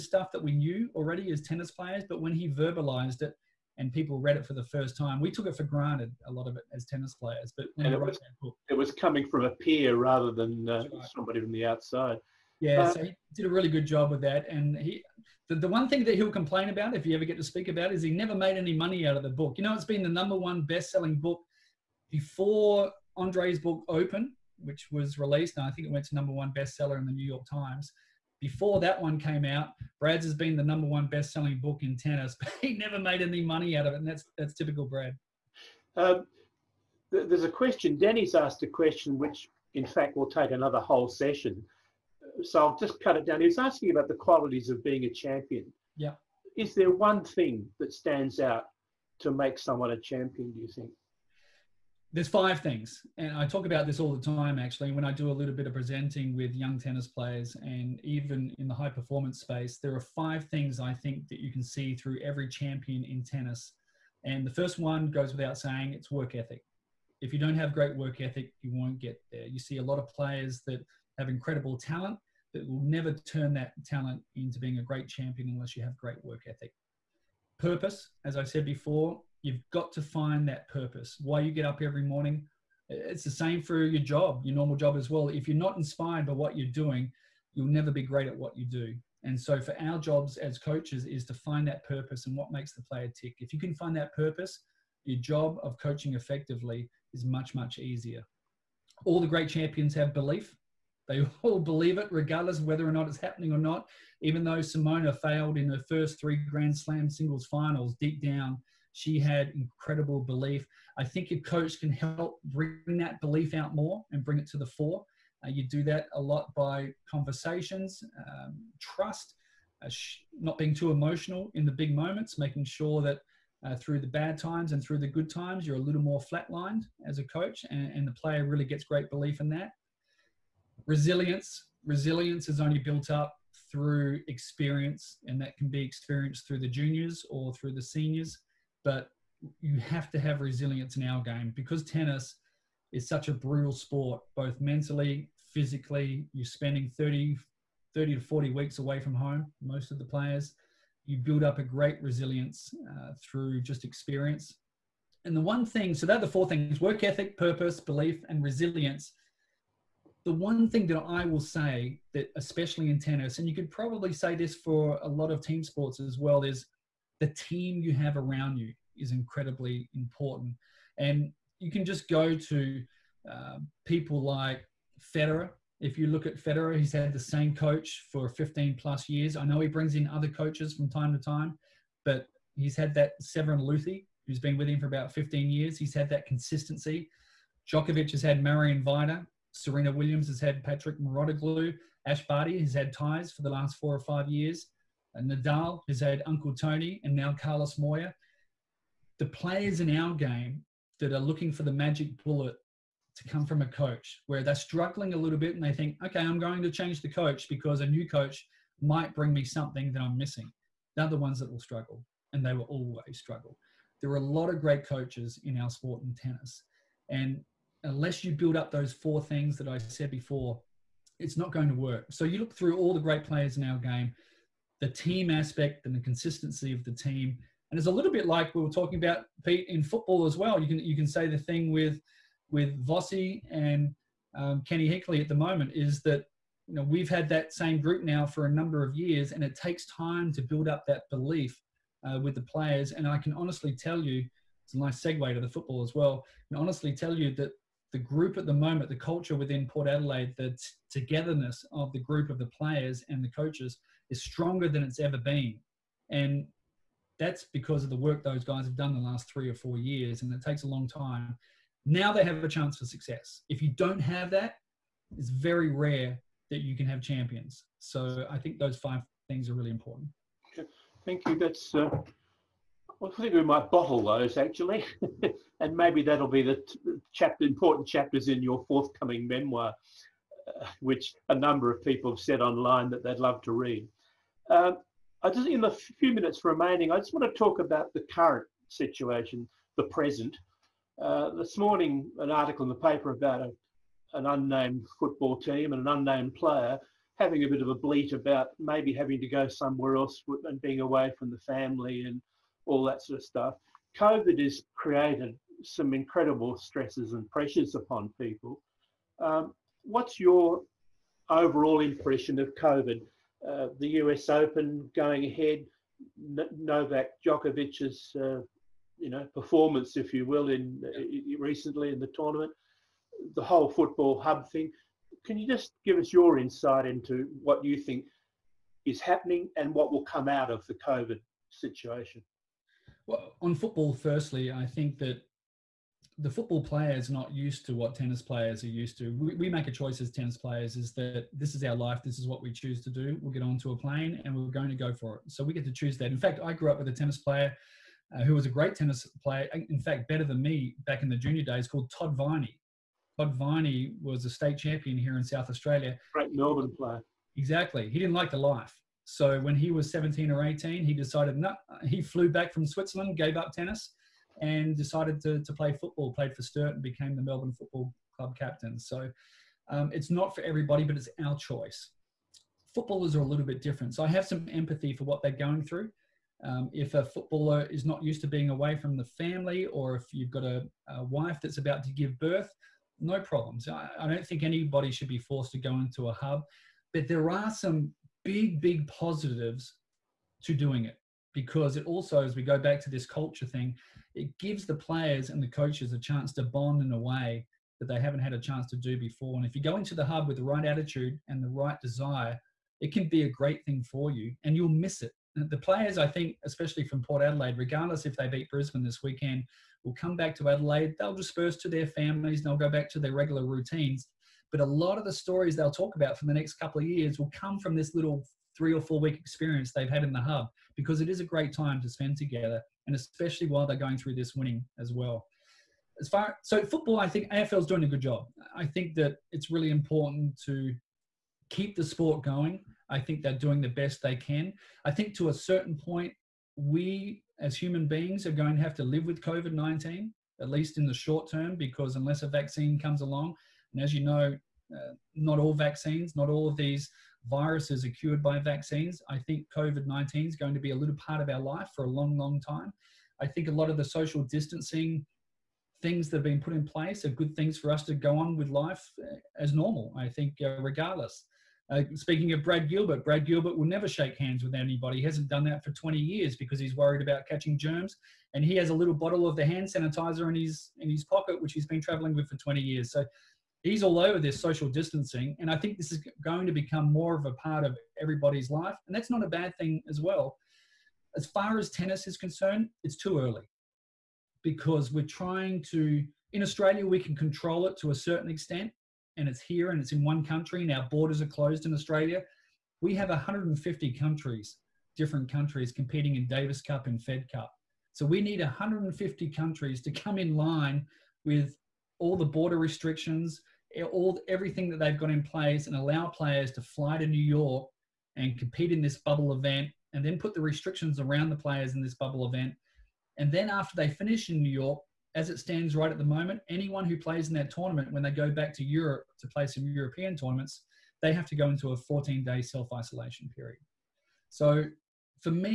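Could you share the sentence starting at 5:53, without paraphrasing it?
Todd Viney was a state champion here in South Australia.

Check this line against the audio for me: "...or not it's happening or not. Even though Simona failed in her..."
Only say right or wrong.
right.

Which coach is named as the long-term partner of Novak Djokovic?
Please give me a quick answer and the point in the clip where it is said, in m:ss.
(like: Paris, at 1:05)
Marian Vajda, at 3:08.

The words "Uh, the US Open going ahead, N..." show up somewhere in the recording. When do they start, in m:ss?
5:13.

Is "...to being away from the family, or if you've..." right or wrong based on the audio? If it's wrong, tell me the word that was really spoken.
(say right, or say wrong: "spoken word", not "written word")
right.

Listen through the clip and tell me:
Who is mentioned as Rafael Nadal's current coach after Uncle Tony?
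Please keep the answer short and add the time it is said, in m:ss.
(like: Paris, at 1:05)
Carlos Moya, at 3:17.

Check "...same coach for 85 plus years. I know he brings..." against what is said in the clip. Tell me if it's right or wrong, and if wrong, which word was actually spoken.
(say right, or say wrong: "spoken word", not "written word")
wrong: "15", not "85".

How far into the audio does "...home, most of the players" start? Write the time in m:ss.
2:29.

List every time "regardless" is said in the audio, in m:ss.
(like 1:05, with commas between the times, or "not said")
1:42, 6:47, 7:40.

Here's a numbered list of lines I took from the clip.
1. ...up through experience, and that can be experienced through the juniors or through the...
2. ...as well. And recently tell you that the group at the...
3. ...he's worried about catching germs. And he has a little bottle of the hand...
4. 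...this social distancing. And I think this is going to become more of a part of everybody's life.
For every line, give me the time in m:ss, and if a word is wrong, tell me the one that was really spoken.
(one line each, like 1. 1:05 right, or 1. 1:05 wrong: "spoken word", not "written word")
1. 2:13 right
2. 4:05 wrong: "honestly", not "recently"
3. 7:46 right
4. 7:54 right.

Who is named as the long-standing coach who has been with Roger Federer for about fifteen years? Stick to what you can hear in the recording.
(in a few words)
Severin Luthi.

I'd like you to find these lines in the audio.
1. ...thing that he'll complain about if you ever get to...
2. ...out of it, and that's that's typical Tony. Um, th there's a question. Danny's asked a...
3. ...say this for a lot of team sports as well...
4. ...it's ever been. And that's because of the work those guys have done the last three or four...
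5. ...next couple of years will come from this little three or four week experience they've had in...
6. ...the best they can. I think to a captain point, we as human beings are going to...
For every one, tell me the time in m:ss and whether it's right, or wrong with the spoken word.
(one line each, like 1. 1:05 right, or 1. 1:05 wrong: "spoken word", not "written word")
1. 0:15 right
2. 0:33 wrong: "Brad", not "Tony"
3. 2:44 right
4. 4:14 right
5. 6:56 right
6. 7:13 wrong: "certain", not "captain".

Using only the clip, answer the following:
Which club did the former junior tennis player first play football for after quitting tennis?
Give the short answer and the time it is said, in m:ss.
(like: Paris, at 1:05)
Sturt, at 6:06.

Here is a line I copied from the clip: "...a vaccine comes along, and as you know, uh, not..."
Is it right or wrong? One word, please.
right.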